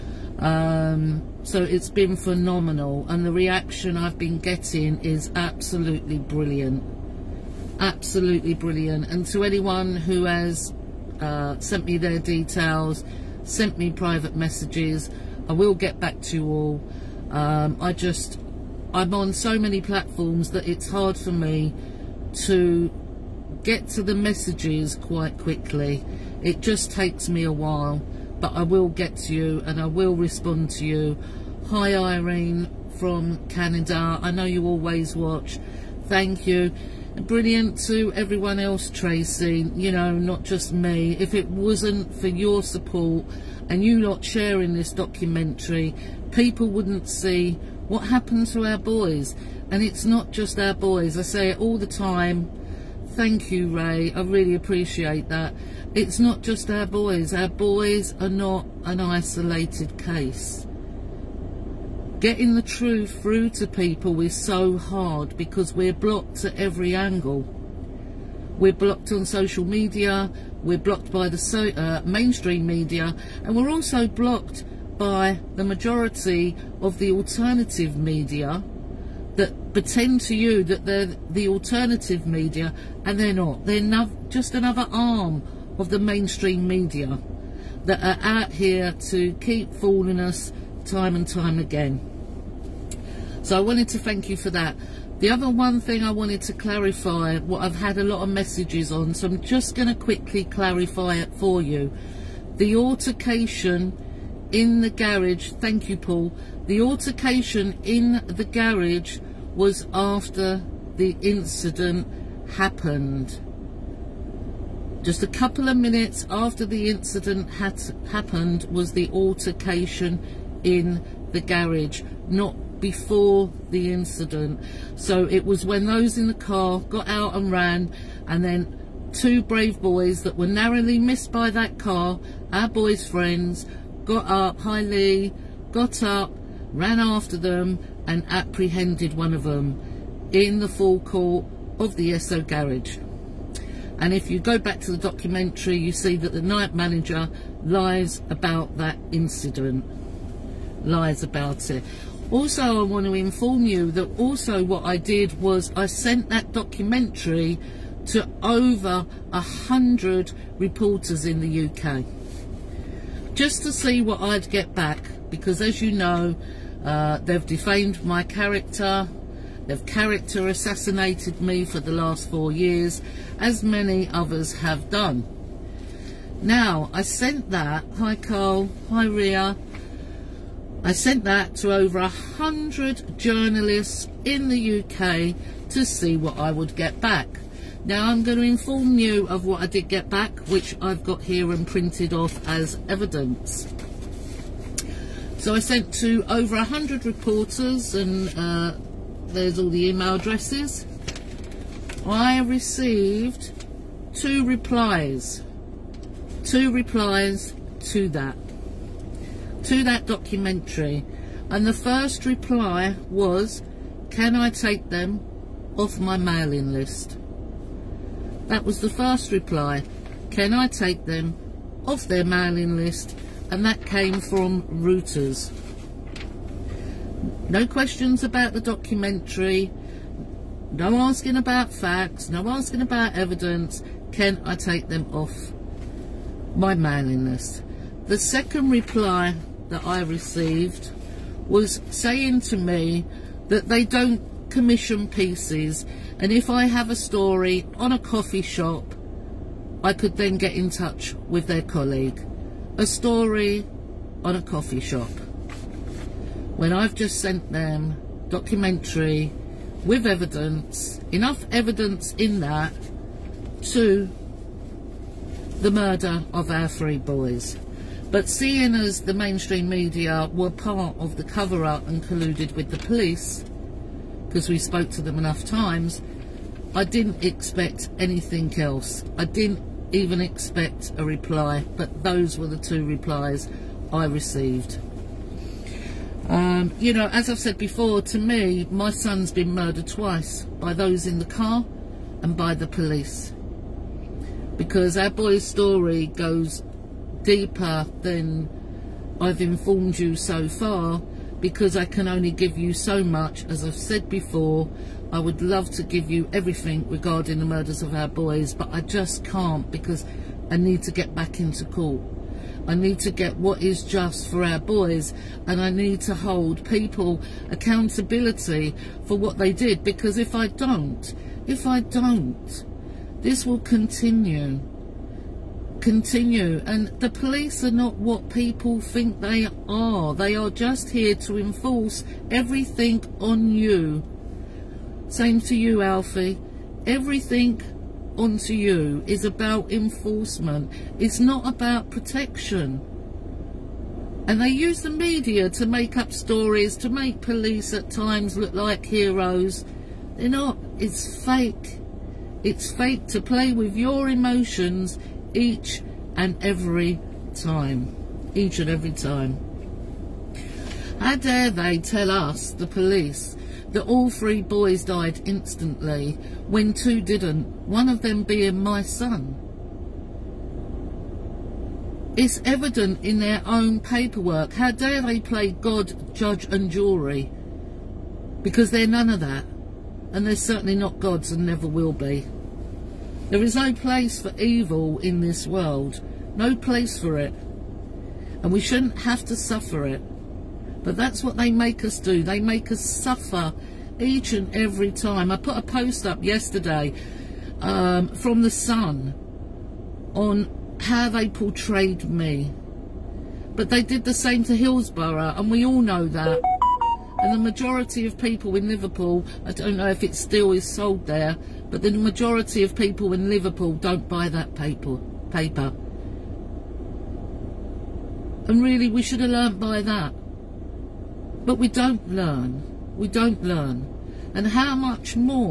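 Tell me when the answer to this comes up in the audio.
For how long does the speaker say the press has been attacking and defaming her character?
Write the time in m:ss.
2:52.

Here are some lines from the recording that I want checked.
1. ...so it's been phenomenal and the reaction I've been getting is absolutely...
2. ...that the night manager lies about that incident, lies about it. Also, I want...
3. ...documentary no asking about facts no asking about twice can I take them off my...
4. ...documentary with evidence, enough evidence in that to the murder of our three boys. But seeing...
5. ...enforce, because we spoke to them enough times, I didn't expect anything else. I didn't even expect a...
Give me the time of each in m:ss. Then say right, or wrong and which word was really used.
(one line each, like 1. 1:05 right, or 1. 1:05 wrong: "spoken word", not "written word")
1. 0:01 right
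2. 2:26 right
3. 3:48 wrong: "evidence", not "twice"
4. 4:18 right
5. 4:32 wrong: "police", not "enforce".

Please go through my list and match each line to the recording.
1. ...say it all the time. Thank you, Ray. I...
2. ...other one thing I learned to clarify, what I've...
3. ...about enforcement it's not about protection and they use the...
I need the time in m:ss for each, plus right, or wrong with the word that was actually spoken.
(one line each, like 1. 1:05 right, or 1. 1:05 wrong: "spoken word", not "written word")
1. 0:51 right
2. 1:35 wrong: "wanted", not "learned"
3. 5:39 right.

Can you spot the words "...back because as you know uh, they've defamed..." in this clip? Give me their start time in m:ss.
2:44.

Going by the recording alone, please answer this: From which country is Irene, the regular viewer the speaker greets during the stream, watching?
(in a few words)
Canada.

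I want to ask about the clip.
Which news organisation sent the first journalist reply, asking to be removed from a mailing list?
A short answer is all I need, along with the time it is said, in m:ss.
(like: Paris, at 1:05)
Reuters, at 3:44.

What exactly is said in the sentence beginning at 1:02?
Getting the truth through to people is so hard because we're blocked at every angle.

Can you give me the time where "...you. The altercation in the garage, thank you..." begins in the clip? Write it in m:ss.
1:41.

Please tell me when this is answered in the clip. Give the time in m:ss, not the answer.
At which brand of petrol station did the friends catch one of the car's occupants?
2:22.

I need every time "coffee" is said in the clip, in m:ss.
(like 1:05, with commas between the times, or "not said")
4:07, 4:14.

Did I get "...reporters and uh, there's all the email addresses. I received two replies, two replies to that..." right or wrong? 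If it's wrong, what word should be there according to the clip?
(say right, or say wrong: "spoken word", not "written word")
right.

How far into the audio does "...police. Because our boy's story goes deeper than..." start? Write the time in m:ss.
4:52.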